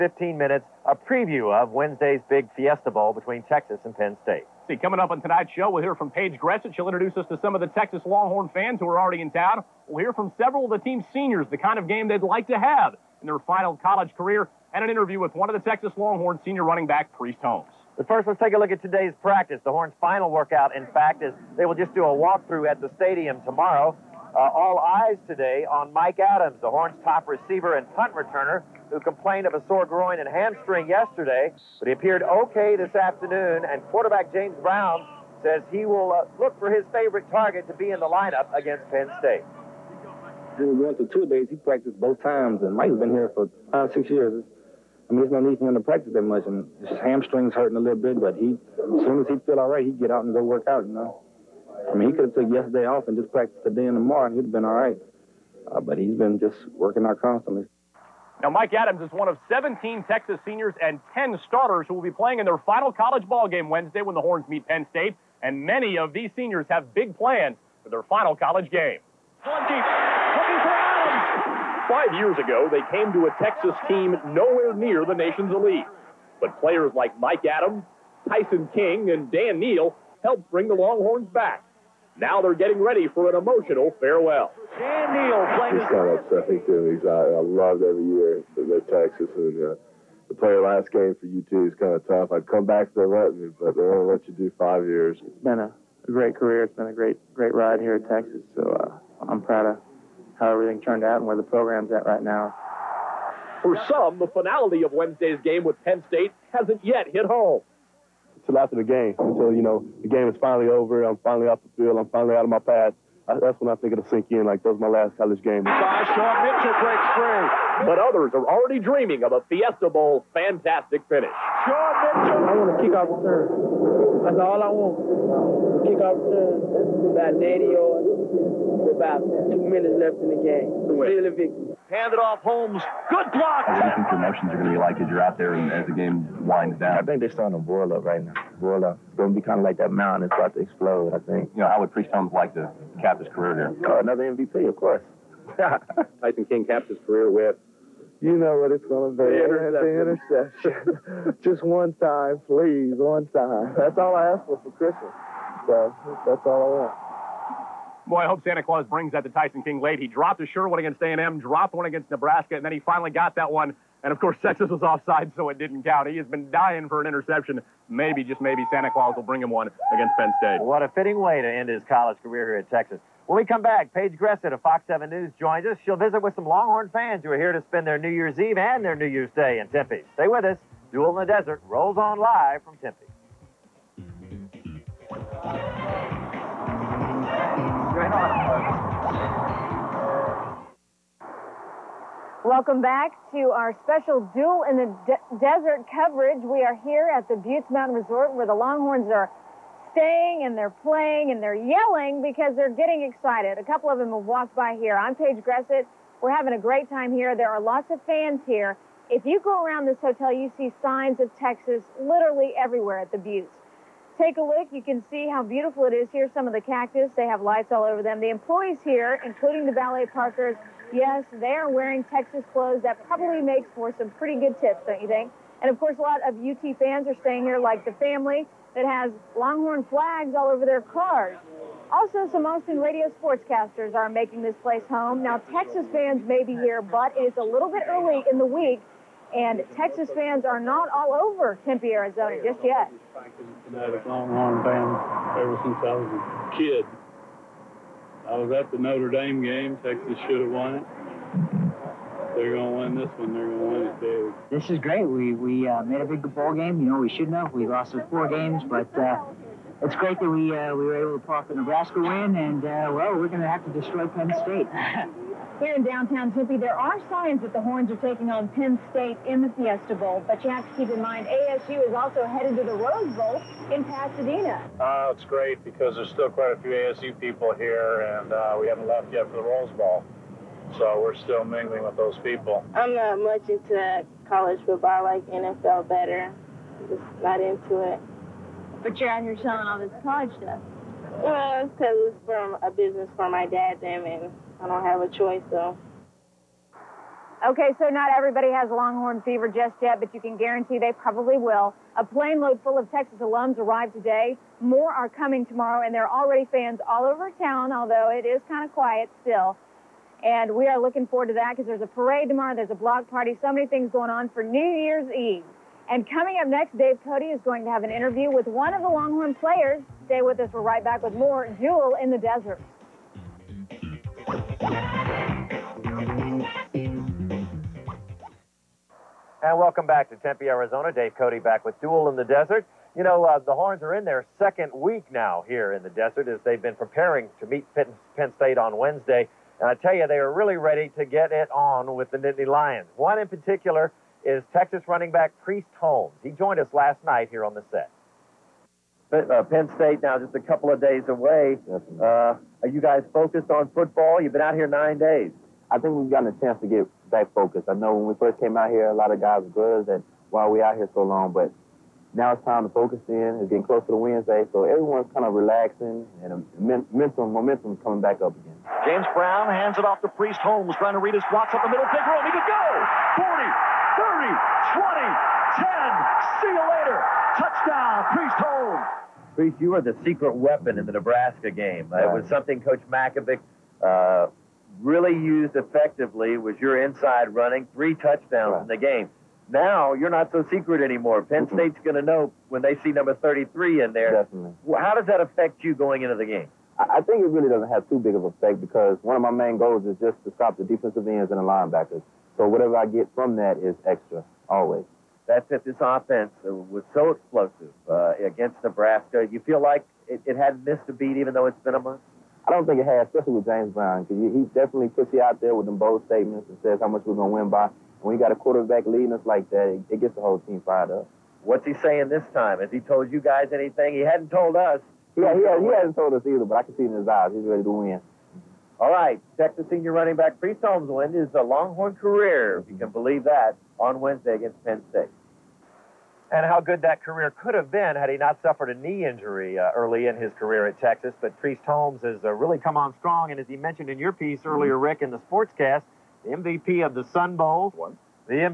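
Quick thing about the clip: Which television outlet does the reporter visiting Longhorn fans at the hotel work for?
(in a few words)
Fox 7 News.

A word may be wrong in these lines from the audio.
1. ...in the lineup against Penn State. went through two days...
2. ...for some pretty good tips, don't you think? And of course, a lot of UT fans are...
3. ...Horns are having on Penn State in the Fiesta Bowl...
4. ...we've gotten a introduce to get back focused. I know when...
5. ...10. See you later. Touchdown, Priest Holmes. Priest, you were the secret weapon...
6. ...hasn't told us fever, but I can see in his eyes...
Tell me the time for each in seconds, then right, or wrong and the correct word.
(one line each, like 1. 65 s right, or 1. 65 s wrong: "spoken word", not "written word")
1. 37 s right
2. 223 s right
3. 267 s wrong: "taking", not "having"
4. 355 s wrong: "chance", not "introduce"
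5. 374 s right
6. 425 s wrong: "either", not "fever".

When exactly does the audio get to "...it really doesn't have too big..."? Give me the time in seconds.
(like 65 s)
397 s.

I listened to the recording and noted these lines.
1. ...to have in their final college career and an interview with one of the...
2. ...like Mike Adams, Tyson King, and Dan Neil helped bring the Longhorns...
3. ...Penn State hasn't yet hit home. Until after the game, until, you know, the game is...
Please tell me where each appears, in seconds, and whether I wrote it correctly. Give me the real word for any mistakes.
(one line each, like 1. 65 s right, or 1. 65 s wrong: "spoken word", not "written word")
1. 12 s right
2. 76 s right
3. 105 s right.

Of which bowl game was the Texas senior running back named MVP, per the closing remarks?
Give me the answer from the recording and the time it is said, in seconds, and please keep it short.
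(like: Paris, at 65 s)
Sun Bowl, at 447 s.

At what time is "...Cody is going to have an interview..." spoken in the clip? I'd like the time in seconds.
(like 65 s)
317 s.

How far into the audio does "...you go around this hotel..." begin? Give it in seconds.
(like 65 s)
209 s.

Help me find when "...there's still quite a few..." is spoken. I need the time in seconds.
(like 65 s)
275 s.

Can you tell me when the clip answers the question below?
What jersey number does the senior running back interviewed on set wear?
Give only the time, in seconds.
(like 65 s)
393 s.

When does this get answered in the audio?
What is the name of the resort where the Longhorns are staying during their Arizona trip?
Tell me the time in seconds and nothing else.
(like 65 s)
197 s.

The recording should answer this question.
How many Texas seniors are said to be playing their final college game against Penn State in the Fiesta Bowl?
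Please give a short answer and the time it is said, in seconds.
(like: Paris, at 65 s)
17, at 59 s.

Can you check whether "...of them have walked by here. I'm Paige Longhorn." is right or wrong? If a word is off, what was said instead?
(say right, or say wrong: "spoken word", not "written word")
wrong: "Gressett", not "Longhorn".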